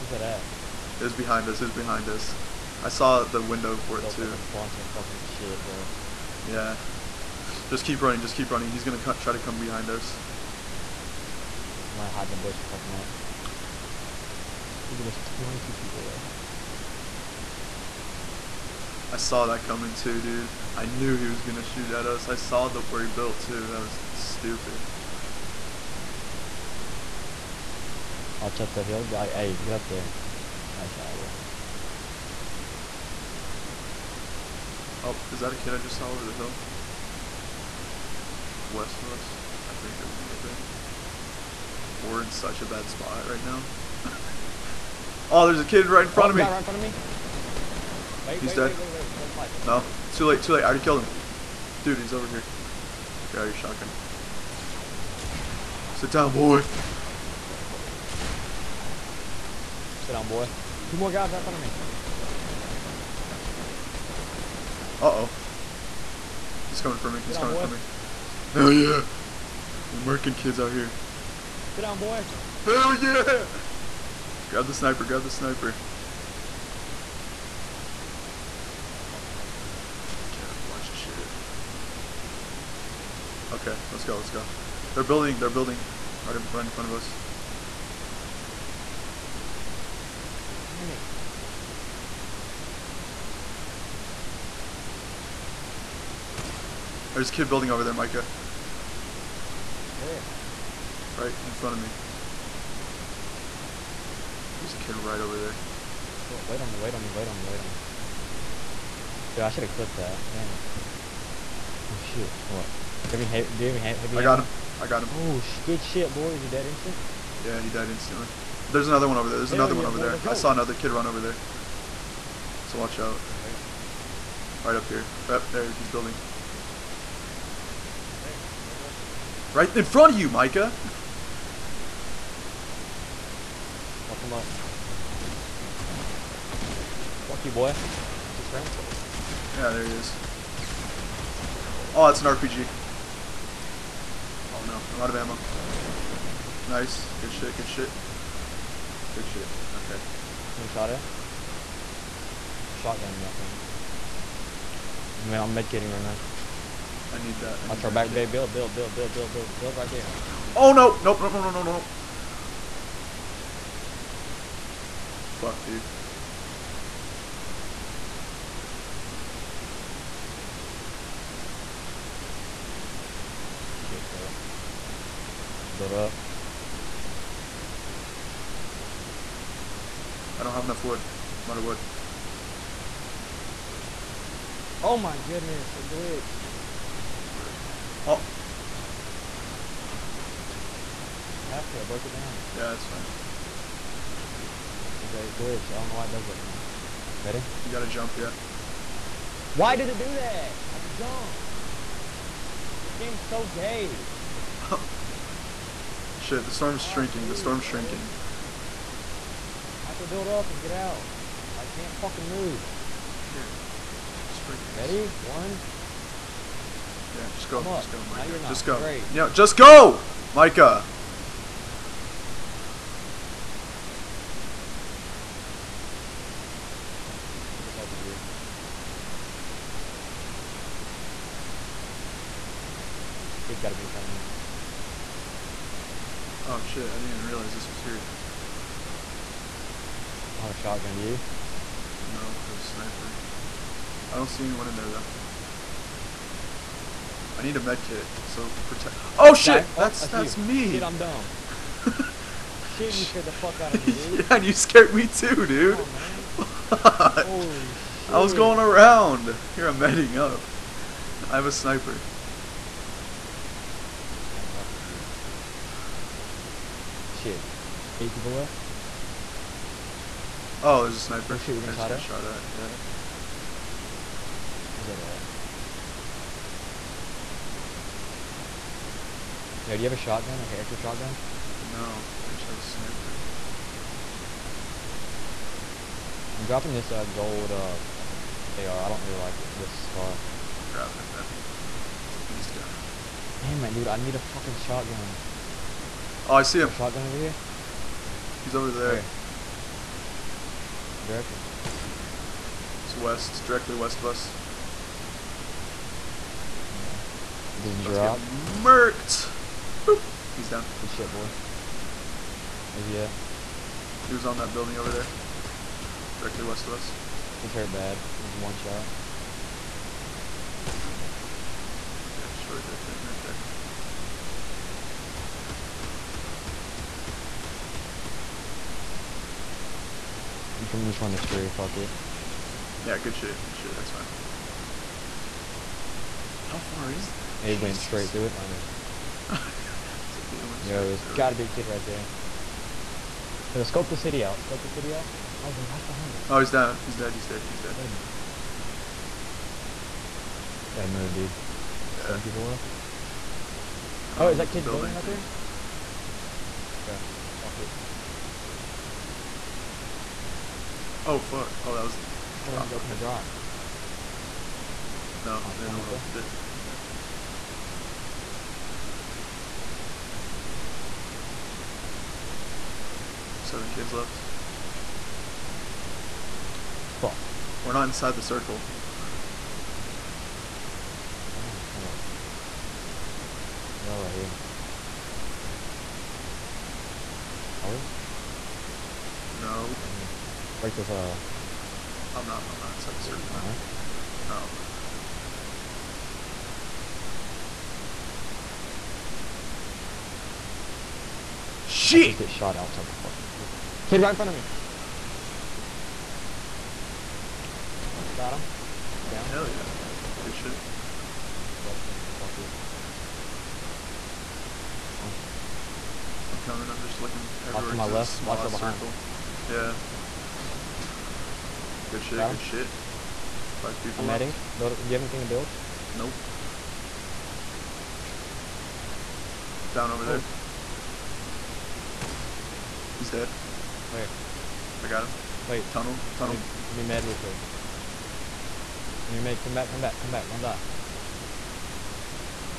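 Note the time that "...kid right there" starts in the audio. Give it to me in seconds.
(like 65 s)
341 s.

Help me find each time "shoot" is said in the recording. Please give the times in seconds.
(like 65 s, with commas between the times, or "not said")
21 s.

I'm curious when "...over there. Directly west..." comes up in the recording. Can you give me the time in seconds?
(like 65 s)
314 s.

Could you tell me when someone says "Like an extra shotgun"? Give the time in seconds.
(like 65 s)
280 s.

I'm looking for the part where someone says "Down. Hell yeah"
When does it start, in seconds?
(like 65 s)
409 s.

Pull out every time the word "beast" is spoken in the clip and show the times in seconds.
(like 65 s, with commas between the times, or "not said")
292 s.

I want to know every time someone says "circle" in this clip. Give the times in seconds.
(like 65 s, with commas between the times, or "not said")
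378 s, 393 s, 403 s.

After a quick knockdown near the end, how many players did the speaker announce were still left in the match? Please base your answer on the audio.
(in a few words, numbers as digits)
5.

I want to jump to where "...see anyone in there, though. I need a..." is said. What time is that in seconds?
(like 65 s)
244 s.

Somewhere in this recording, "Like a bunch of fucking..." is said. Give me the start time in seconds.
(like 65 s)
4 s.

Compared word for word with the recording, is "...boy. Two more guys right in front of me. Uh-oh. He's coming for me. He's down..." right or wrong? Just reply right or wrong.
right.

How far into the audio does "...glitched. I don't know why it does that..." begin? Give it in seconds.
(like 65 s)
195 s.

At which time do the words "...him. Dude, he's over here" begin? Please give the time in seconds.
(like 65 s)
51 s.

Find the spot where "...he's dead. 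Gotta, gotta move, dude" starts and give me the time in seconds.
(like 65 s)
347 s.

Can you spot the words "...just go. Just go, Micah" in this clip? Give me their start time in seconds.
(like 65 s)
217 s.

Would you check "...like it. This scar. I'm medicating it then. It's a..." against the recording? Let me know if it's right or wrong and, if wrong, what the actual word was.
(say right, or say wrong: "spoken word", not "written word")
wrong: "grabbing", not "medicating".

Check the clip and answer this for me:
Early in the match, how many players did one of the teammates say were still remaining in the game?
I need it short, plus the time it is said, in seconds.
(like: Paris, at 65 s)
22, at 15 s.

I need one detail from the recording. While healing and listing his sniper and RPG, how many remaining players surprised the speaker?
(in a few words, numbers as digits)
8.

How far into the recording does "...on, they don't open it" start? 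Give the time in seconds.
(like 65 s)
365 s.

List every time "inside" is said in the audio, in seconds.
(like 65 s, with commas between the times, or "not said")
377 s, 392 s.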